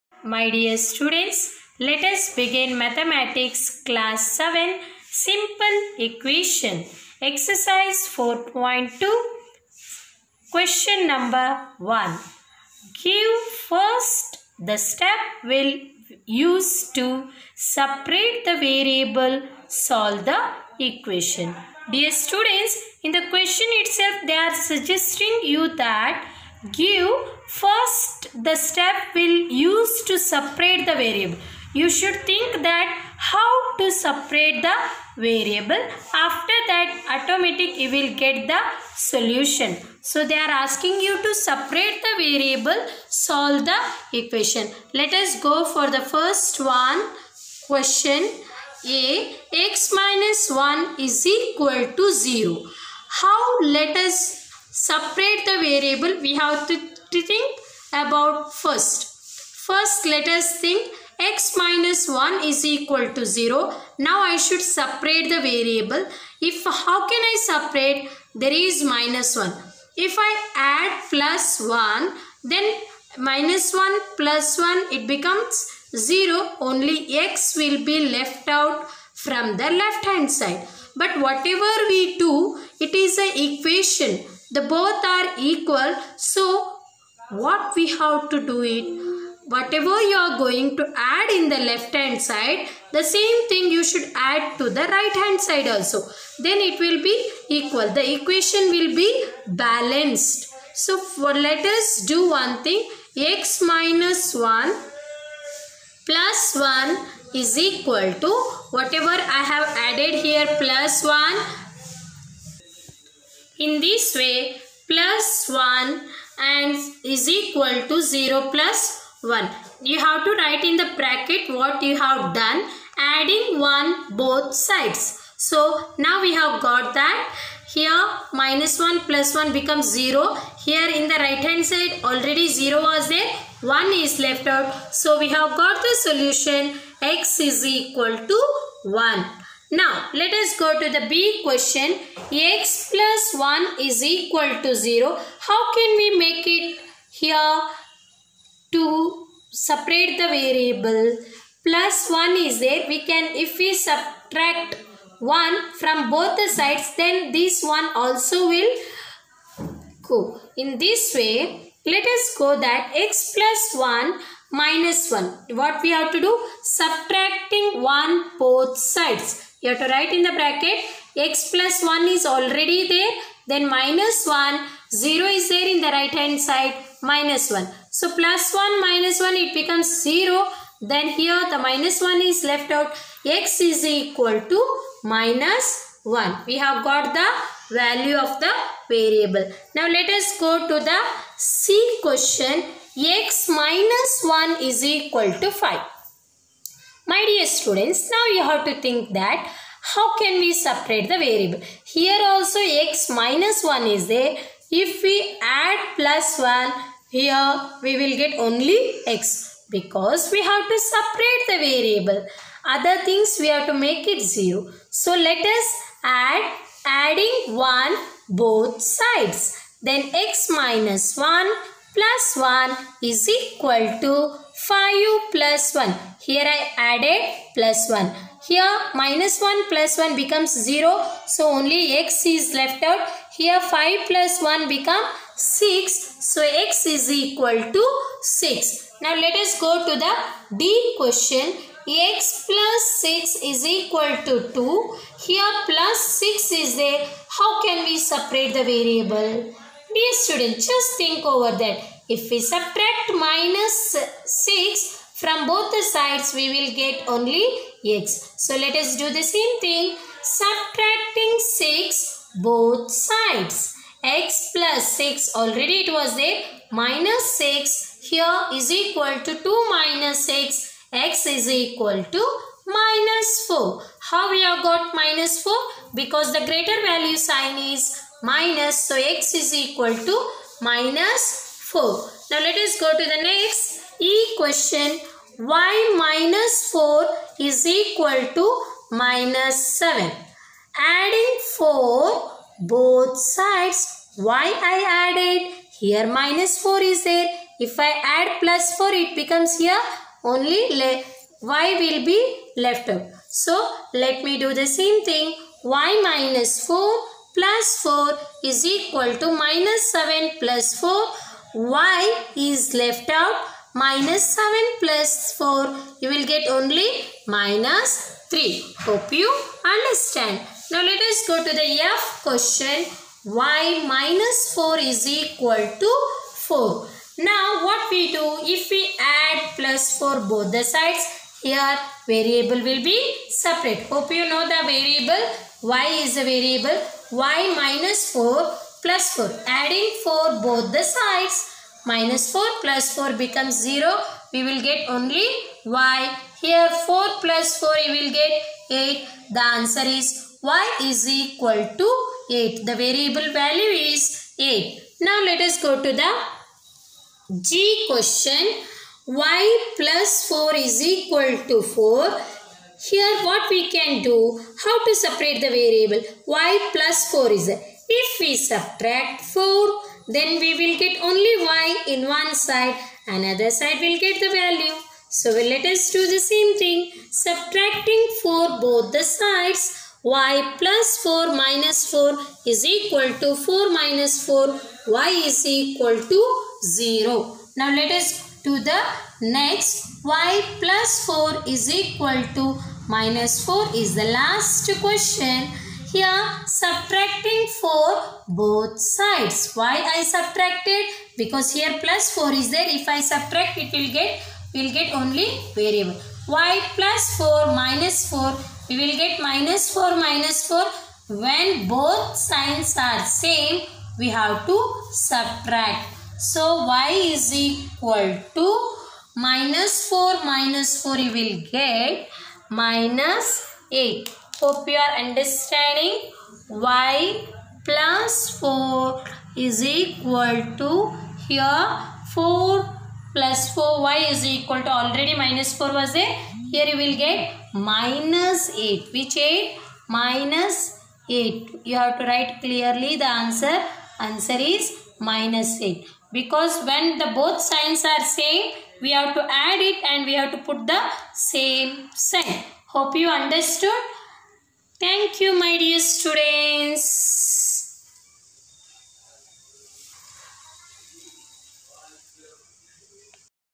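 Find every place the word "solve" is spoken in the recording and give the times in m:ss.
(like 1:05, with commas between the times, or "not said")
0:19, 0:43.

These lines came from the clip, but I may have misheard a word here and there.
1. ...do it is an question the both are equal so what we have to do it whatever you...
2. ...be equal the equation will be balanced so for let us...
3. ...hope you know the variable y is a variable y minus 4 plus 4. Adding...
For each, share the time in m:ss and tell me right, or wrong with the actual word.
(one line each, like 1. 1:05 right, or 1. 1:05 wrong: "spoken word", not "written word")
1. 1:22 wrong: "equation", not "question"
2. 1:37 right
3. 5:33 right.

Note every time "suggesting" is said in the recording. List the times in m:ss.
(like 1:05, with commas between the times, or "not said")
0:24.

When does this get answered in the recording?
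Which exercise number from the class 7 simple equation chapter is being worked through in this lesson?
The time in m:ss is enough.
0:07.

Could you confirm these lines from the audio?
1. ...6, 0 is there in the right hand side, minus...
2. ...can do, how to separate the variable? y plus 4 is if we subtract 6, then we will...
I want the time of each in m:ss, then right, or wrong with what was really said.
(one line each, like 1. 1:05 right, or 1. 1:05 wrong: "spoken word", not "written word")
1. 2:54 wrong: "1", not "6"
2. 6:03 wrong: "4", not "6".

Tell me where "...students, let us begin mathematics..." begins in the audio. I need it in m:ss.
0:00.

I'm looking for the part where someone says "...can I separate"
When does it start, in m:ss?
1:07.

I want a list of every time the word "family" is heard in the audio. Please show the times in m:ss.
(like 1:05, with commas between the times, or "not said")
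not said.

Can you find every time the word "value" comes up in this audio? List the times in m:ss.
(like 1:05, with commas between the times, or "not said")
3:07, 4:36, 5:53, 6:14.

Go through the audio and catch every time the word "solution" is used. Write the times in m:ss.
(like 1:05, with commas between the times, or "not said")
0:38, 2:16.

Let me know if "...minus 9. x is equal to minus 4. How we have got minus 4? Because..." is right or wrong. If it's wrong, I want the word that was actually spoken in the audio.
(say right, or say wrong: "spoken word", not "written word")
wrong: "6", not "9".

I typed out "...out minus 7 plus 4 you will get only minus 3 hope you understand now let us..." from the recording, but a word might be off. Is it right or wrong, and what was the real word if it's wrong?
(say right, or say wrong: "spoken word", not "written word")
right.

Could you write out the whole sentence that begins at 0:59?
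First let us think x minus 1 is equal to 0.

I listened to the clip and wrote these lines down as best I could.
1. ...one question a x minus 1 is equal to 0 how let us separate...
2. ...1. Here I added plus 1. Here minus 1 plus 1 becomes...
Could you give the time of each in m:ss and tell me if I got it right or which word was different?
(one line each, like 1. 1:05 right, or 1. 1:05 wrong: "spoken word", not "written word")
1. 0:46 right
2. 3:45 right.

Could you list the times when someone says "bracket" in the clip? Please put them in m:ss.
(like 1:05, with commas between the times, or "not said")
2:00, 2:50.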